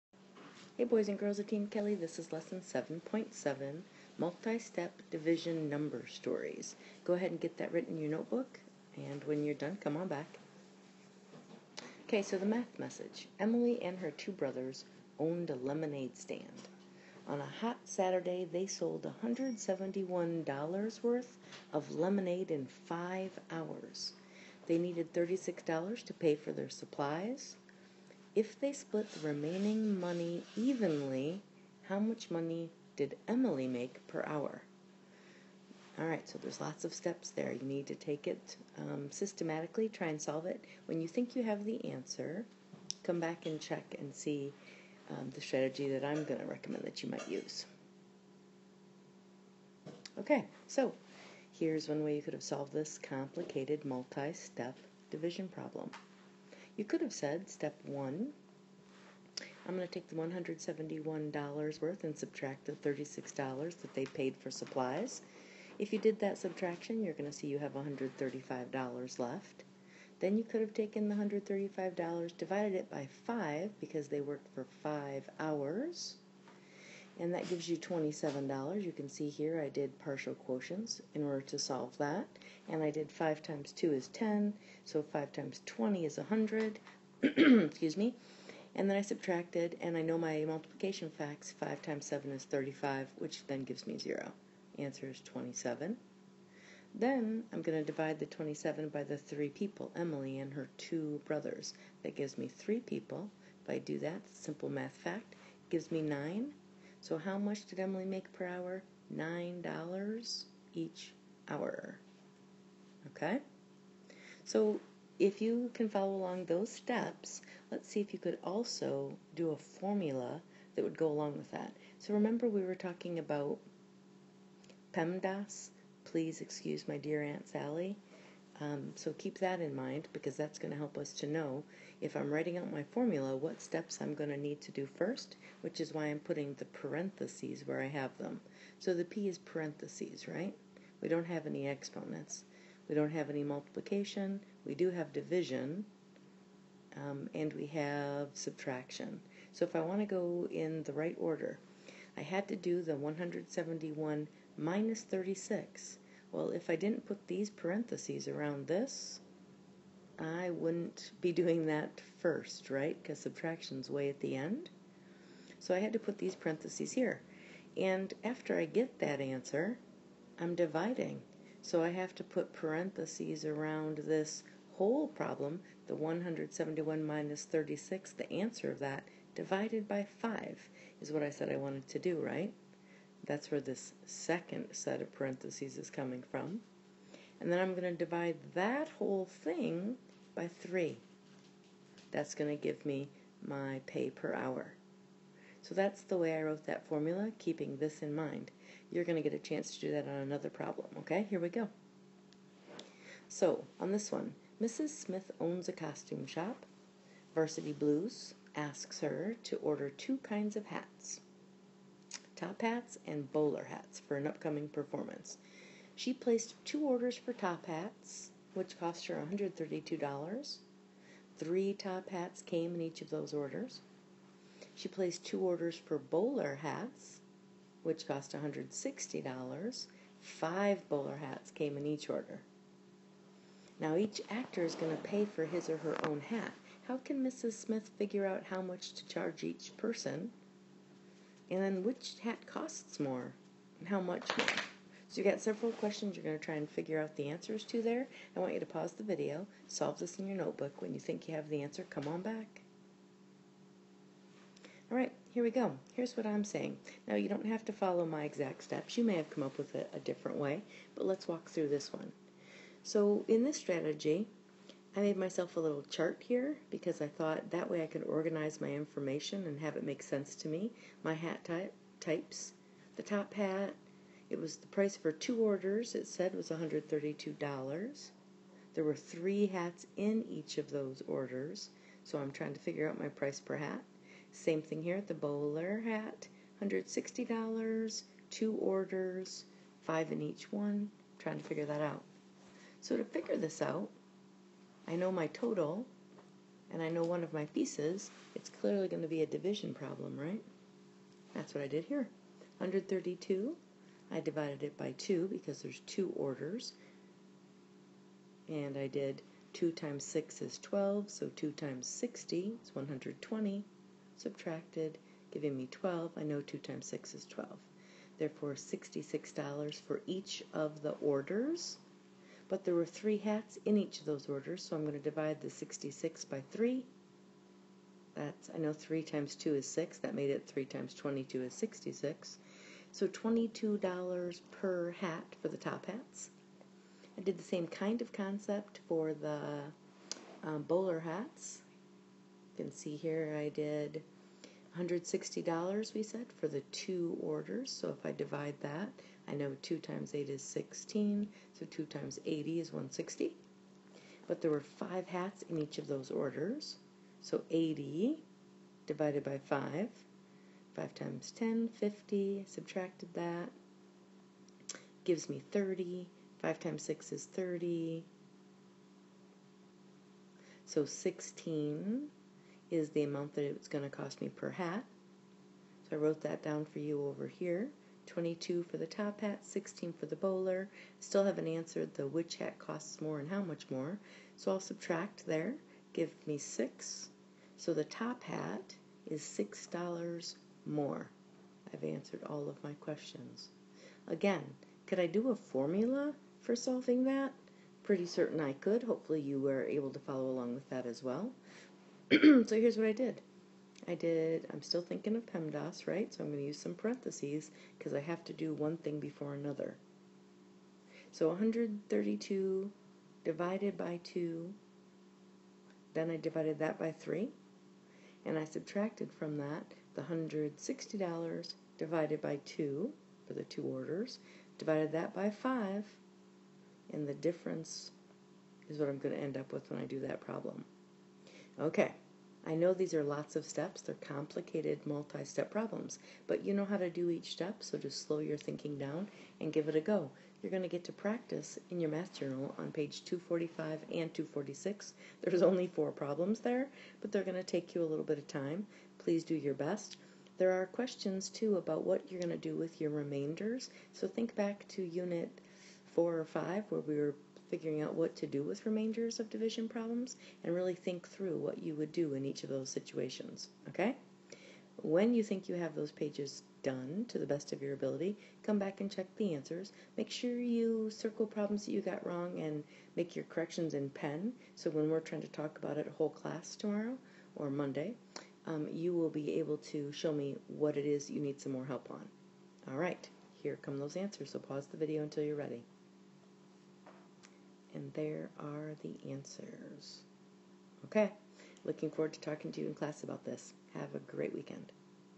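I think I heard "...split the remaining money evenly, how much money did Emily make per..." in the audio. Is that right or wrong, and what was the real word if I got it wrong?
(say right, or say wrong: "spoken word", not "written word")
right.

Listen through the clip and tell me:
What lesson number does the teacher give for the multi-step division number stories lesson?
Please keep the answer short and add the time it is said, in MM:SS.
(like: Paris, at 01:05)
7.7, at 00:02.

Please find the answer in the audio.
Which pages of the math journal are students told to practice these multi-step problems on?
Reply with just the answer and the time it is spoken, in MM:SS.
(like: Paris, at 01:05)
245 and 246, at 07:23.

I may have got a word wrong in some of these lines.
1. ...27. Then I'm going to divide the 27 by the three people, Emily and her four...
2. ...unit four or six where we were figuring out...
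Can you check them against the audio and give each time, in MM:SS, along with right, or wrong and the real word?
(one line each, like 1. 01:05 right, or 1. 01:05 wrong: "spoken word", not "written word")
1. 01:35 wrong: "two", not "four"
2. 07:34 wrong: "five", not "six".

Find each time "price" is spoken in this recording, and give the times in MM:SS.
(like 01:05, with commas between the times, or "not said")
04:34, 04:43.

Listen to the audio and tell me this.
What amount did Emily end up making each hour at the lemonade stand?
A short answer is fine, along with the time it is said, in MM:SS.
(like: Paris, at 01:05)
$9, at 01:49.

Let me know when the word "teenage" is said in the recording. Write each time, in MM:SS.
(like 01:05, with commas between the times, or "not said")
not said.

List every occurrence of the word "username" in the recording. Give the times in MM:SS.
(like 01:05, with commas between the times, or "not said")
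not said.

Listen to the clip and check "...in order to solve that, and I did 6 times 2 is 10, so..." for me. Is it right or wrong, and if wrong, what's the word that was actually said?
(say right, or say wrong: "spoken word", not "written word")
wrong: "5", not "6".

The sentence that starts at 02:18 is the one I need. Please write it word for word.
So the P is parentheses, right?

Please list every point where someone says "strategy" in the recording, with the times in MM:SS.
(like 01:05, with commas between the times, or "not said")
00:45, 04:23.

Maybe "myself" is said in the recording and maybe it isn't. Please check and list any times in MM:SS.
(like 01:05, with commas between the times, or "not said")
04:25.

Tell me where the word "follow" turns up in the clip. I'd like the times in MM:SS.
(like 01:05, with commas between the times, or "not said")
01:55, 04:17, 06:39.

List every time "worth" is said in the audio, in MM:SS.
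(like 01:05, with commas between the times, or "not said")
00:21, 01:01.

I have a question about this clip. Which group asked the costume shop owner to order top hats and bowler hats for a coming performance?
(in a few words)
Varsity Blues.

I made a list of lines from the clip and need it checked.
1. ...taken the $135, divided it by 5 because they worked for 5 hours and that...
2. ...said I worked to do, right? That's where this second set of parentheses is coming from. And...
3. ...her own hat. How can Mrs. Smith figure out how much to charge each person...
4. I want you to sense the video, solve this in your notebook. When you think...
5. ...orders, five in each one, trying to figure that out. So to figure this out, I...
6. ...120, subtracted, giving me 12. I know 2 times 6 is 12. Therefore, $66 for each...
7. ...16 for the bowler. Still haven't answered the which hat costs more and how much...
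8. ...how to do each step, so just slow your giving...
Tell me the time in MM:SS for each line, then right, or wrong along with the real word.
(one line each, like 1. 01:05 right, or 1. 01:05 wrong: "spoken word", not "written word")
1. 01:10 right
2. 03:01 wrong: "wanted", not "worked"
3. 03:55 right
4. 04:08 wrong: "pause", not "sense"
5. 04:48 right
6. 05:12 right
7. 06:19 right
8. 07:16 wrong: "thinking", not "giving".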